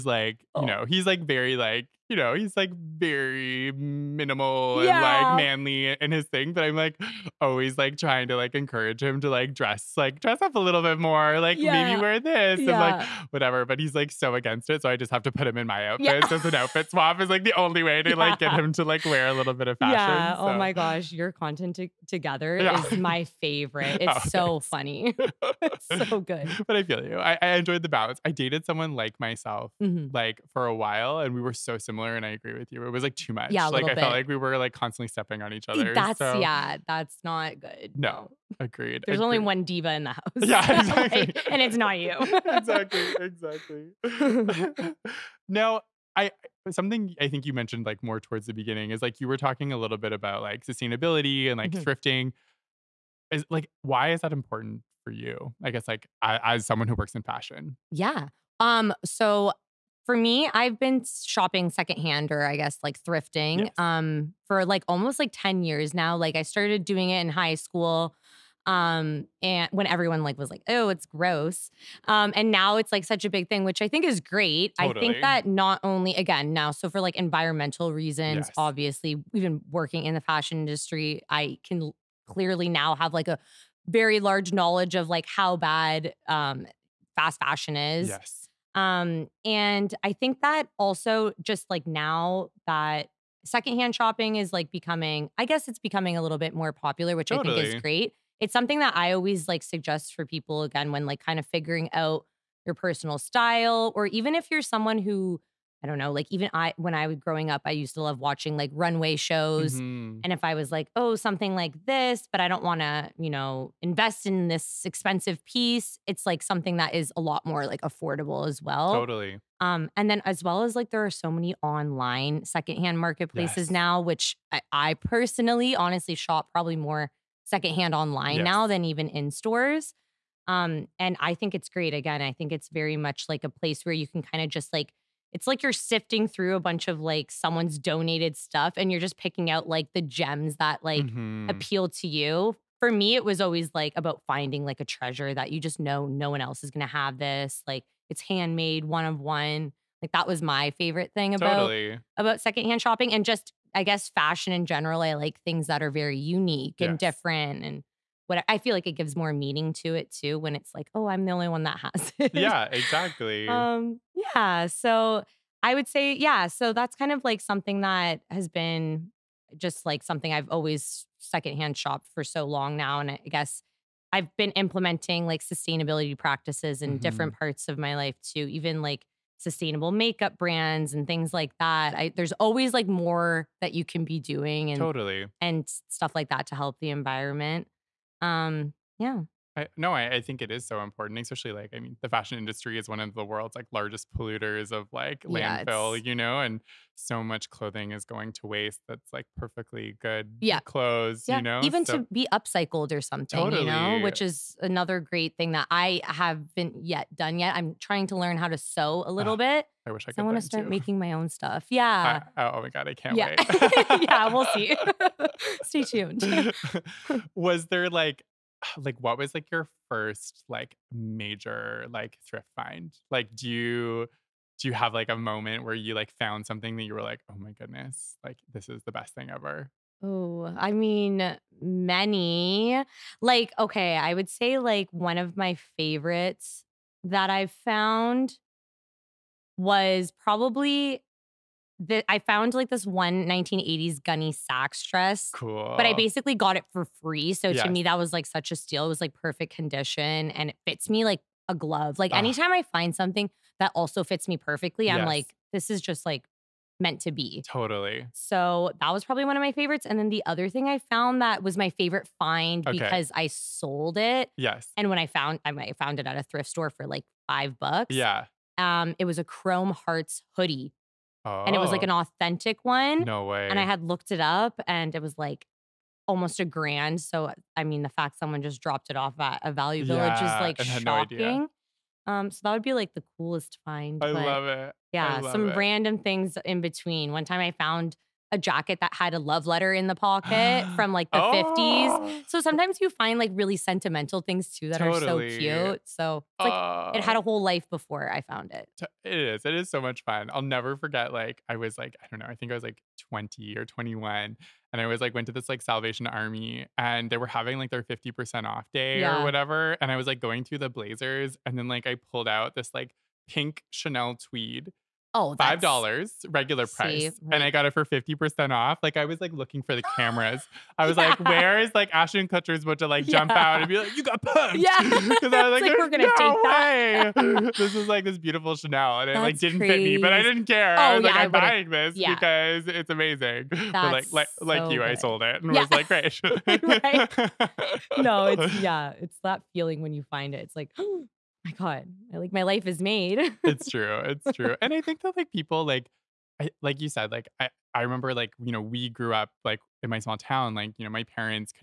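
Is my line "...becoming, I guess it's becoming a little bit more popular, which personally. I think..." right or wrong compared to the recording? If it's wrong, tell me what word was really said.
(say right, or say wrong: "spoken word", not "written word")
wrong: "totally", not "personally".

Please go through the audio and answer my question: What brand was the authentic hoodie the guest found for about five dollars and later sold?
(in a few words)
Chrome Hearts.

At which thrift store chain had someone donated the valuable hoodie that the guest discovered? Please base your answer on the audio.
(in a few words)
Value Village.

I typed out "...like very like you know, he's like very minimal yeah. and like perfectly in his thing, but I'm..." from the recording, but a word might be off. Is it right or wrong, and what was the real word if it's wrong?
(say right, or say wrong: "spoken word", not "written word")
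wrong: "manly", not "perfectly".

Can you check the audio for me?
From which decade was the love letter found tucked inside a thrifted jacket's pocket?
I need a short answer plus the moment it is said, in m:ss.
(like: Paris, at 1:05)
the 1950s, at 4:51.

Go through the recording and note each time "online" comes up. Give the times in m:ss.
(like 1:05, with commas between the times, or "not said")
2:01, 2:07.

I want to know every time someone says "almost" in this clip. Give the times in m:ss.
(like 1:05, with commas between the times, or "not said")
1:04, 4:36.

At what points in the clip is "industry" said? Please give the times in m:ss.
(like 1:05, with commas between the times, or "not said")
1:20, 3:12.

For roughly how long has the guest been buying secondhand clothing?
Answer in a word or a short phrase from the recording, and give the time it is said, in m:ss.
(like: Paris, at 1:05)
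10 years, at 1:05.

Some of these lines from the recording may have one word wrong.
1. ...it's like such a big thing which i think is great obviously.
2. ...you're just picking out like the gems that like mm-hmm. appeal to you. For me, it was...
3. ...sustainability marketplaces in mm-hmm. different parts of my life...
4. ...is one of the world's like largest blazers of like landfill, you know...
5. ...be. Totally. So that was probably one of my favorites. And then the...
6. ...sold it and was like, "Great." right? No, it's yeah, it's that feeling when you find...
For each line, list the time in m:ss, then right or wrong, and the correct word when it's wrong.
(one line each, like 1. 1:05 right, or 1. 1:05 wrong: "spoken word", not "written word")
1. 1:12 wrong: "totally", not "obviously"
2. 2:18 right
3. 2:55 wrong: "practices", not "marketplaces"
4. 3:12 wrong: "polluters", not "blazers"
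5. 4:17 right
6. 5:34 right.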